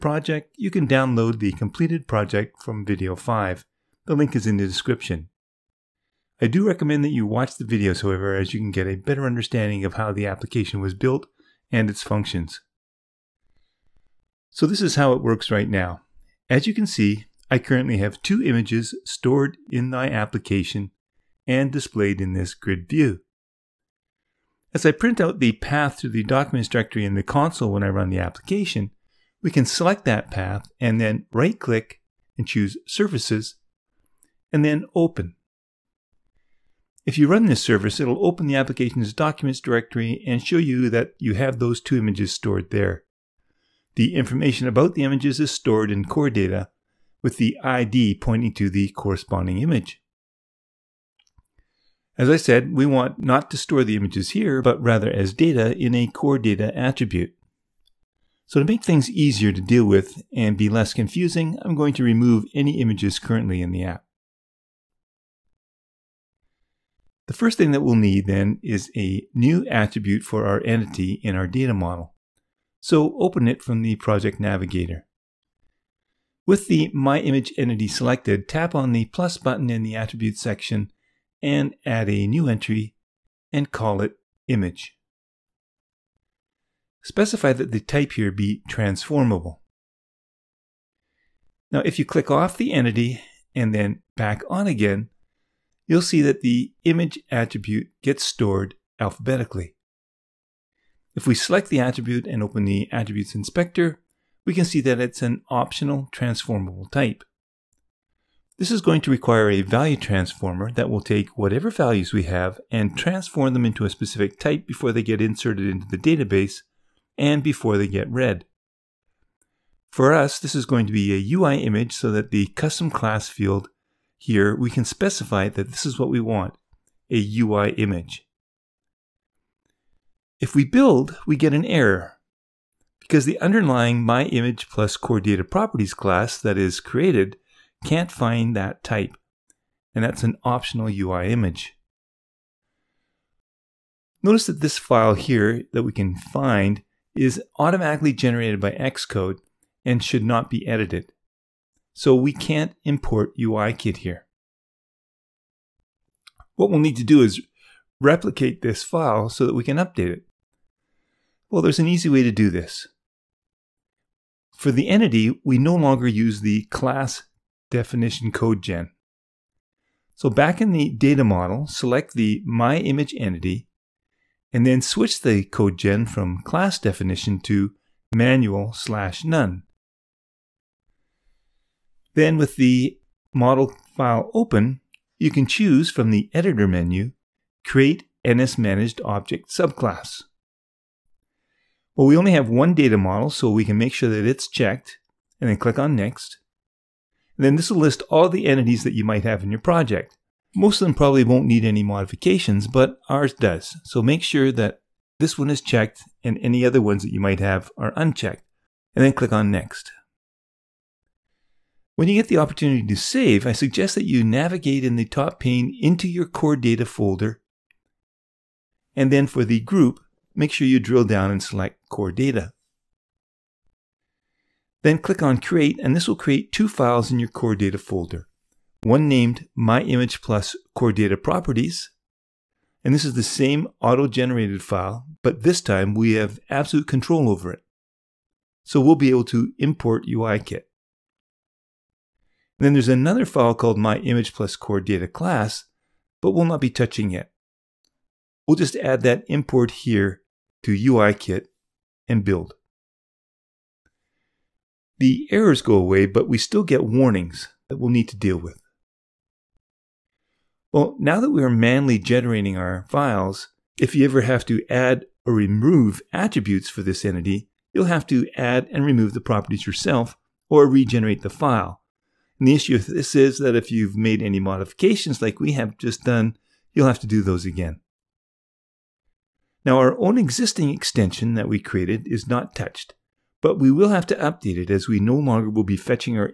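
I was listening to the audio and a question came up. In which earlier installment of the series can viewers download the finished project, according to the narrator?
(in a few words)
Video 5.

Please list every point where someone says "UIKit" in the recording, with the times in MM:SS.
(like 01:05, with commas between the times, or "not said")
02:33, 04:00, 04:10.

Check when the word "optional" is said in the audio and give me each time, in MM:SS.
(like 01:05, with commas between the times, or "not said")
01:45, 02:20.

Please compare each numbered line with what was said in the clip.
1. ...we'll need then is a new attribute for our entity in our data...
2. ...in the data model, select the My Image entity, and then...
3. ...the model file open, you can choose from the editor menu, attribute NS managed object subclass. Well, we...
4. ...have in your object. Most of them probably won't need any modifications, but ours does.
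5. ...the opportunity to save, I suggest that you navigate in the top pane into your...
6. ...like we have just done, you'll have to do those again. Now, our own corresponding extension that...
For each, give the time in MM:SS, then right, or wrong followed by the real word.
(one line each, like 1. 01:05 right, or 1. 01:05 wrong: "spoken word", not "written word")
1. 01:07 right
2. 02:50 right
3. 03:02 wrong: "create", not "attribute"
4. 03:19 wrong: "project", not "object"
5. 03:32 right
6. 04:35 wrong: "existing", not "corresponding".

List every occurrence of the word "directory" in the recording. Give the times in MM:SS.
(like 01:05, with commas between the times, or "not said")
00:26, 00:39.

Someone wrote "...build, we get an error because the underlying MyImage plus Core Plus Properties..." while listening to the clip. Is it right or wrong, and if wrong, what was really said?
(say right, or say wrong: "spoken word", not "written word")
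wrong: "Data", not "Plus".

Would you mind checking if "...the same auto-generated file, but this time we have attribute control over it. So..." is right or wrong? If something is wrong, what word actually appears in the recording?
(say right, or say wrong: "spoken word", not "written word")
wrong: "absolute", not "attribute".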